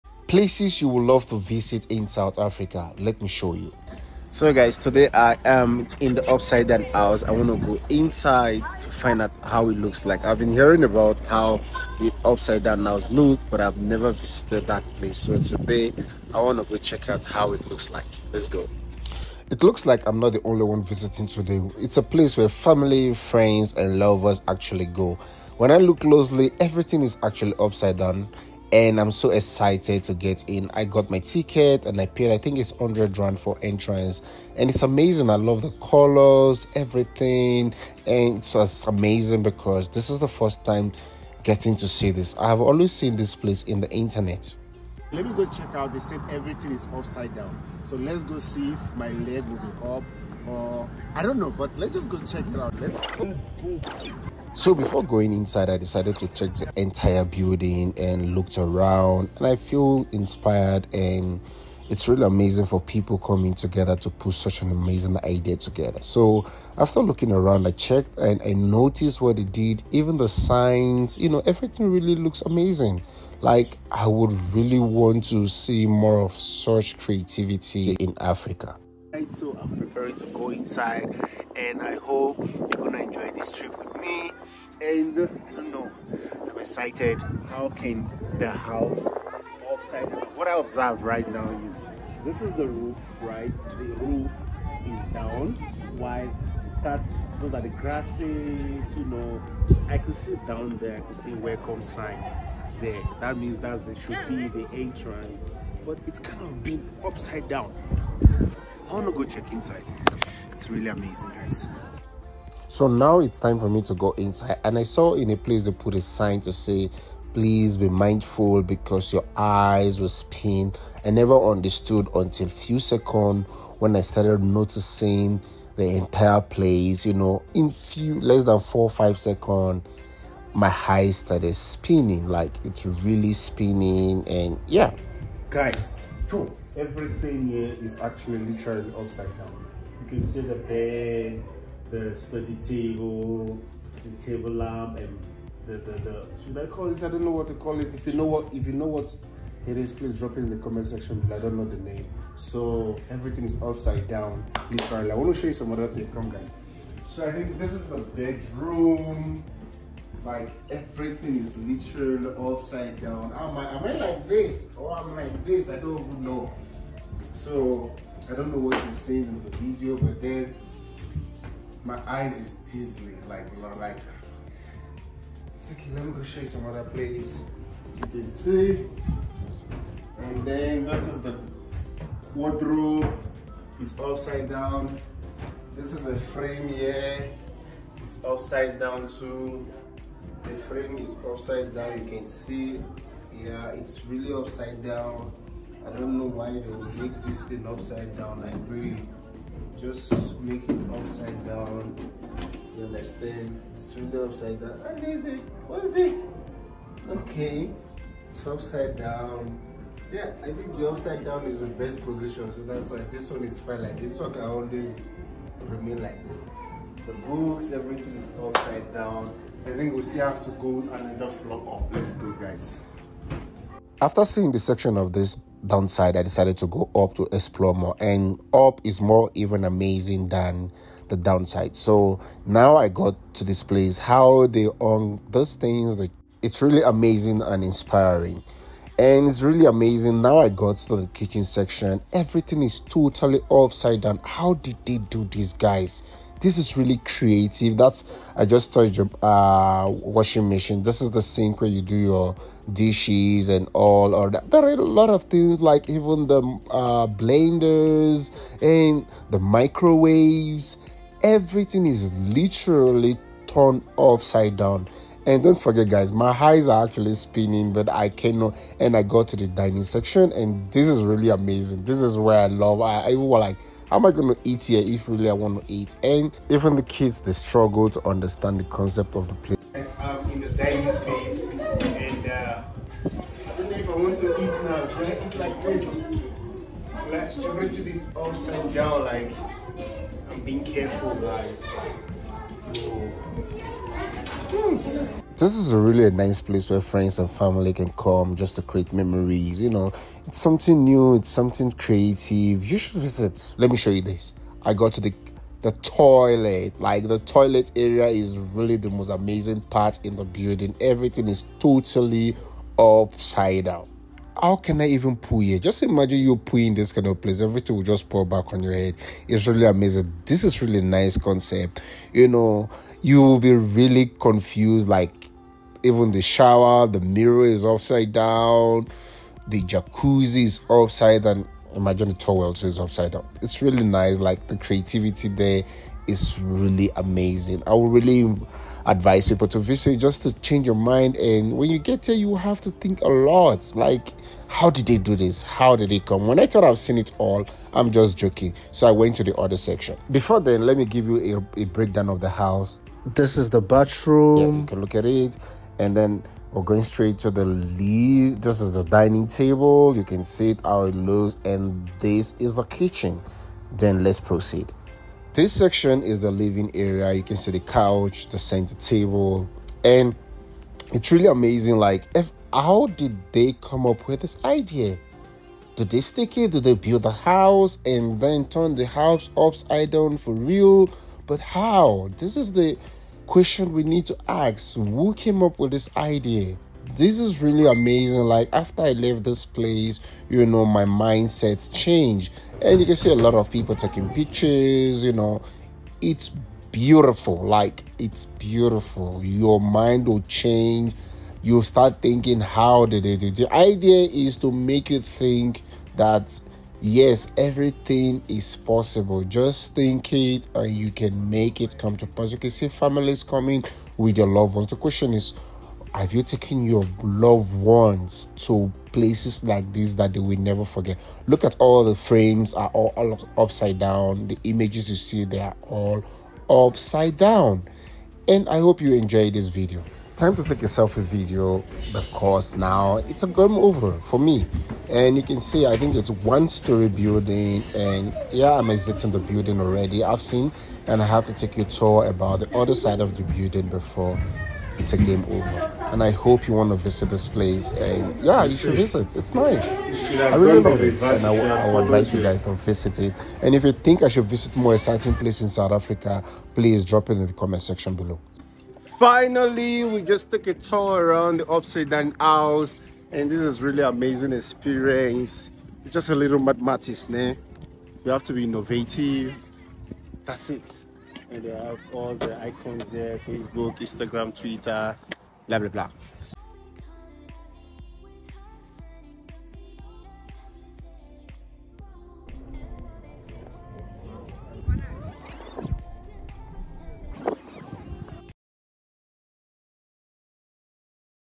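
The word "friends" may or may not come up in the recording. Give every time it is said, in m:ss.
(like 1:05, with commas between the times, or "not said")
0:23, 4:56.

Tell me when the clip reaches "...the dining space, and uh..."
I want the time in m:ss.
4:40.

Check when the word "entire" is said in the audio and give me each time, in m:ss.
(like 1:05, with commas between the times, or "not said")
0:56, 2:05.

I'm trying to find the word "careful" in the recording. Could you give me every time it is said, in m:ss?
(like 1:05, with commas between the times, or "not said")
4:50.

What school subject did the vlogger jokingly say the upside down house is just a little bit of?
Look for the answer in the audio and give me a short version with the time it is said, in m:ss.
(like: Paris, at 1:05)
mathematics, at 7:46.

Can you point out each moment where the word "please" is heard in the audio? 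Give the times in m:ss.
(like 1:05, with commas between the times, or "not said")
1:57, 2:29, 7:36.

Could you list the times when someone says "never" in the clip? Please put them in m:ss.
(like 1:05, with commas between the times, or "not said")
0:13, 2:01, 7:00.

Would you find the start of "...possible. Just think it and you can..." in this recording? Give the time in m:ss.
6:48.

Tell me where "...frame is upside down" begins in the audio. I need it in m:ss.
3:10.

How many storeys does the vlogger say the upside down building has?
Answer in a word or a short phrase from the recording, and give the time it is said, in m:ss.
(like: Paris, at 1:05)
one story, at 7:16.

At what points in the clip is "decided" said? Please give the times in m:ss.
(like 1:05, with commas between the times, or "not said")
0:55, 3:46.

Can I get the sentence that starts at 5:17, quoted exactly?
Everything will just pour back on your head.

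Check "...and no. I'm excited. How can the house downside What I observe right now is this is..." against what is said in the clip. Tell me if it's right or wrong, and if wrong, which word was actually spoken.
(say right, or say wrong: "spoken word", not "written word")
wrong: "upside", not "downside".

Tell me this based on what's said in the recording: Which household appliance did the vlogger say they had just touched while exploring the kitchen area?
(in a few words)
washing machine.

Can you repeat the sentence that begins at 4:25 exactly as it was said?
And don't forget, guys, my eyes are actually spinning, but I cannot.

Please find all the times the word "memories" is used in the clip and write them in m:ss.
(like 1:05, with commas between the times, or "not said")
4:58.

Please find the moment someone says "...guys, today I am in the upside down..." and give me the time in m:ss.
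0:04.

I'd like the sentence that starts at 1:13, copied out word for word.
Like I would really want to see more of such creativity in Africa.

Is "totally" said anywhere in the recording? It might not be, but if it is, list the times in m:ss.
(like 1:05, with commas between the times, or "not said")
4:02, 5:11.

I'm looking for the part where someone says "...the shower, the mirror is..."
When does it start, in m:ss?
5:26.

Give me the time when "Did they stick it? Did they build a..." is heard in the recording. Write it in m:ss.
6:15.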